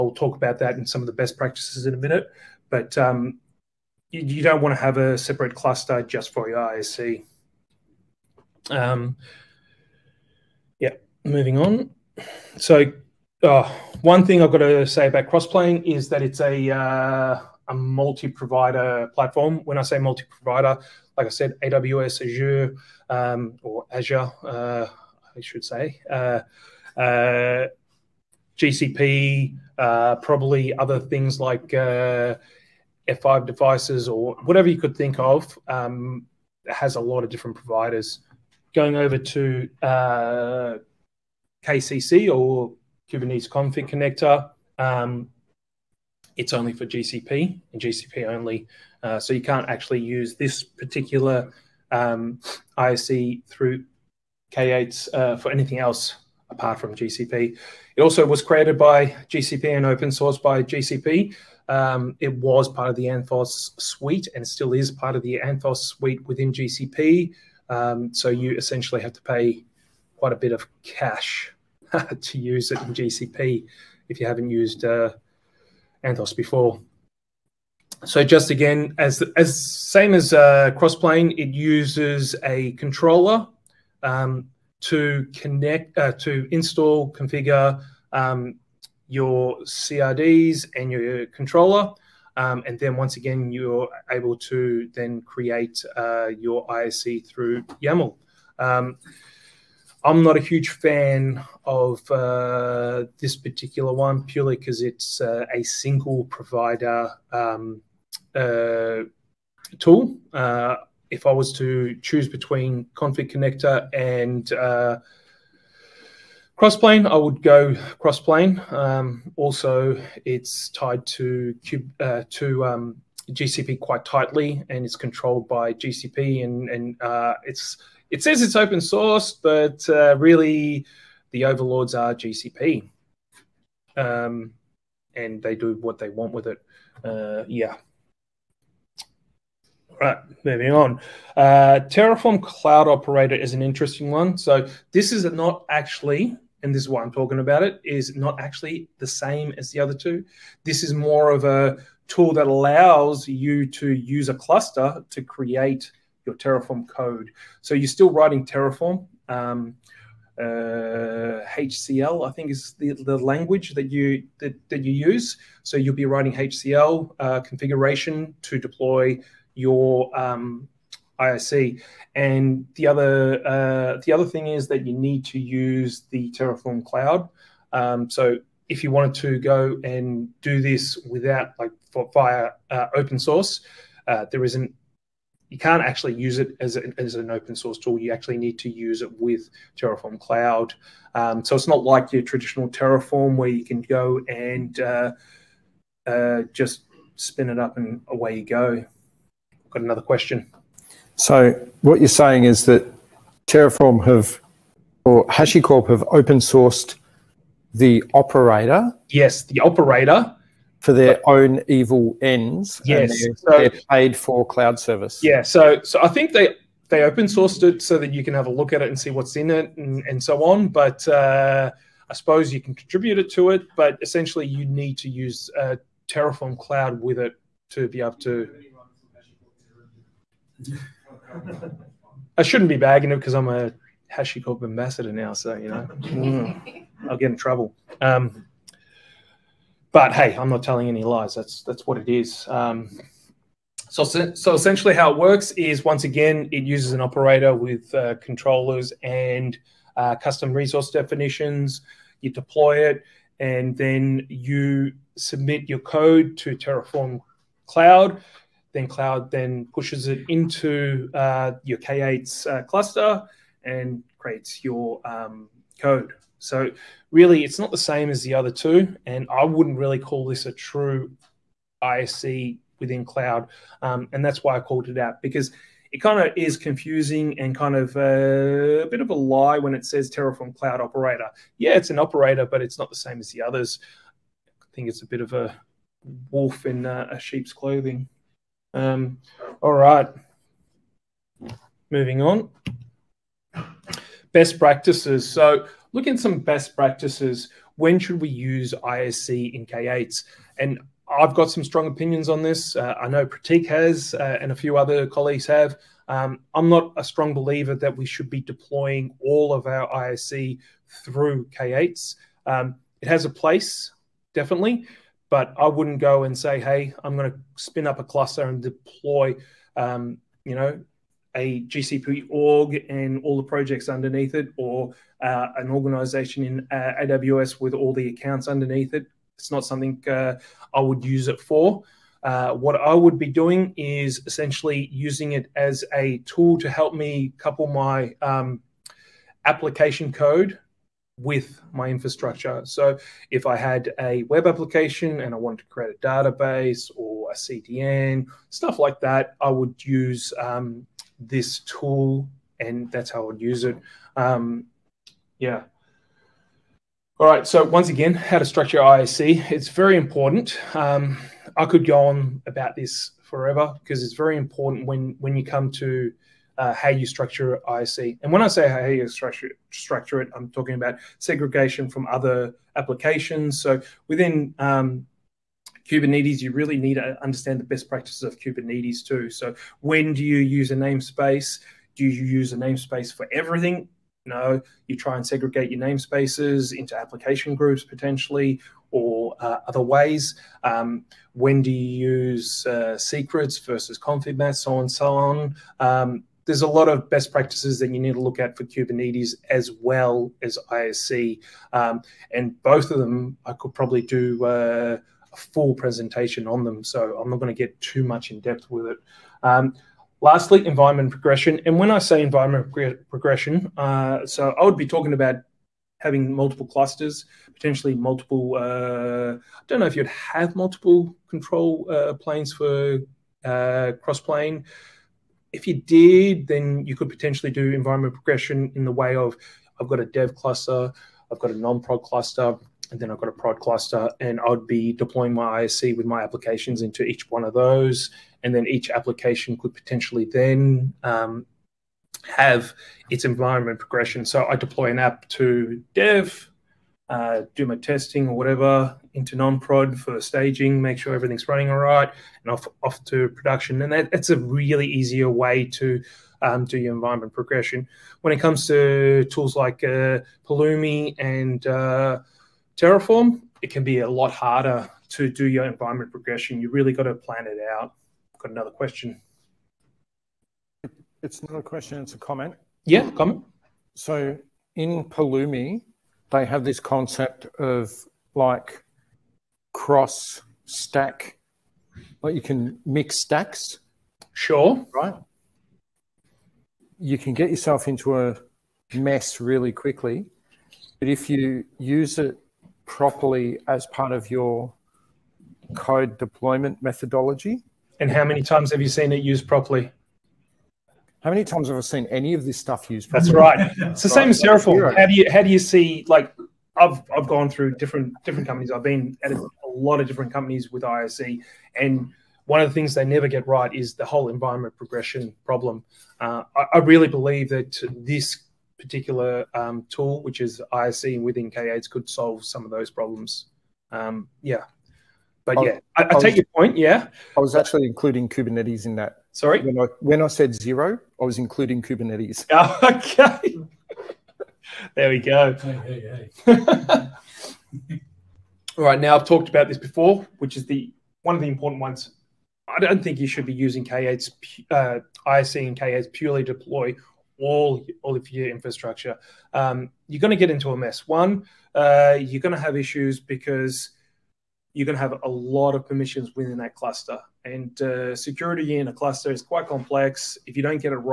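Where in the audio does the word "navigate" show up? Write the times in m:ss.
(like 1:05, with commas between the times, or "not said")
not said.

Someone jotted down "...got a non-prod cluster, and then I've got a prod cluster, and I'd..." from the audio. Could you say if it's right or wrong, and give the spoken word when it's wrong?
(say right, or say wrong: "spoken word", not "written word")
right.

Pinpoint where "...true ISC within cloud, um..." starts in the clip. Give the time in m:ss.
4:30.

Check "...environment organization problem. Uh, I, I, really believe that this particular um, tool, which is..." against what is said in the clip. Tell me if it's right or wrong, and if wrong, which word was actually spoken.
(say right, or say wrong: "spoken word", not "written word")
wrong: "progression", not "organization".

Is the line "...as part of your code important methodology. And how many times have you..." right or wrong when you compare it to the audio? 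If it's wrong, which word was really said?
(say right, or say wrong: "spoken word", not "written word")
wrong: "deployment", not "important".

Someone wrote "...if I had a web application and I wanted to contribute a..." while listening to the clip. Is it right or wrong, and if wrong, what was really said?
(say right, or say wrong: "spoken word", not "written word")
wrong: "create", not "contribute".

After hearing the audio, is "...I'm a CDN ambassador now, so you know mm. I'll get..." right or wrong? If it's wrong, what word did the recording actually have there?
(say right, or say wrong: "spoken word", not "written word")
wrong: "HashiCorp", not "CDN".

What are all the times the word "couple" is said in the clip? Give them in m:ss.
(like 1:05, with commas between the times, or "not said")
5:37.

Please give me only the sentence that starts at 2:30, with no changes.
This is more of a tool that allows you to use a cluster to create your Terraform code.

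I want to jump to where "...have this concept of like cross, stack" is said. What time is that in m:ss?
7:56.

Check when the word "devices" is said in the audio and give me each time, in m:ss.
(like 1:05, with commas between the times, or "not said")
0:33.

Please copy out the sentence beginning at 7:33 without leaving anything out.
And that, that's a really easier way to um, do your environment progression.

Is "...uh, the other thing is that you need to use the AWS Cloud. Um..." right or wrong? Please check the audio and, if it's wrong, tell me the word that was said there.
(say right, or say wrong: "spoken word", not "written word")
wrong: "Terraform", not "AWS".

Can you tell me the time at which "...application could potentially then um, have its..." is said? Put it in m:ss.
7:18.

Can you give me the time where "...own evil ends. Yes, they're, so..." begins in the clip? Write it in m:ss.
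3:31.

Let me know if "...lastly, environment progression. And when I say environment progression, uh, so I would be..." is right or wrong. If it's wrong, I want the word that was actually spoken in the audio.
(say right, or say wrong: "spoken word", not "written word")
right.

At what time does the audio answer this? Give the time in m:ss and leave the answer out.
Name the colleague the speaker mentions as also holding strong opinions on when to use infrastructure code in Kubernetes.
5:03.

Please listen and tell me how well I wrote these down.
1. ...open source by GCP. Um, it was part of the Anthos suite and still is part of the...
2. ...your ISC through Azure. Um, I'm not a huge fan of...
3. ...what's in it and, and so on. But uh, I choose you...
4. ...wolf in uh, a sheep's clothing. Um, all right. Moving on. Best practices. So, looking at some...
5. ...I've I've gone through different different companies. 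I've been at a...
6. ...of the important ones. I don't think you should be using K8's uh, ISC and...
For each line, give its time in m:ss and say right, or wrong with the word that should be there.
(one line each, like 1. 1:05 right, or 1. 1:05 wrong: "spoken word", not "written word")
1. 0:59 right
2. 1:36 wrong: "YAML", not "Azure"
3. 3:39 wrong: "suppose", not "choose"
4. 4:46 right
5. 8:26 right
6. 9:01 right.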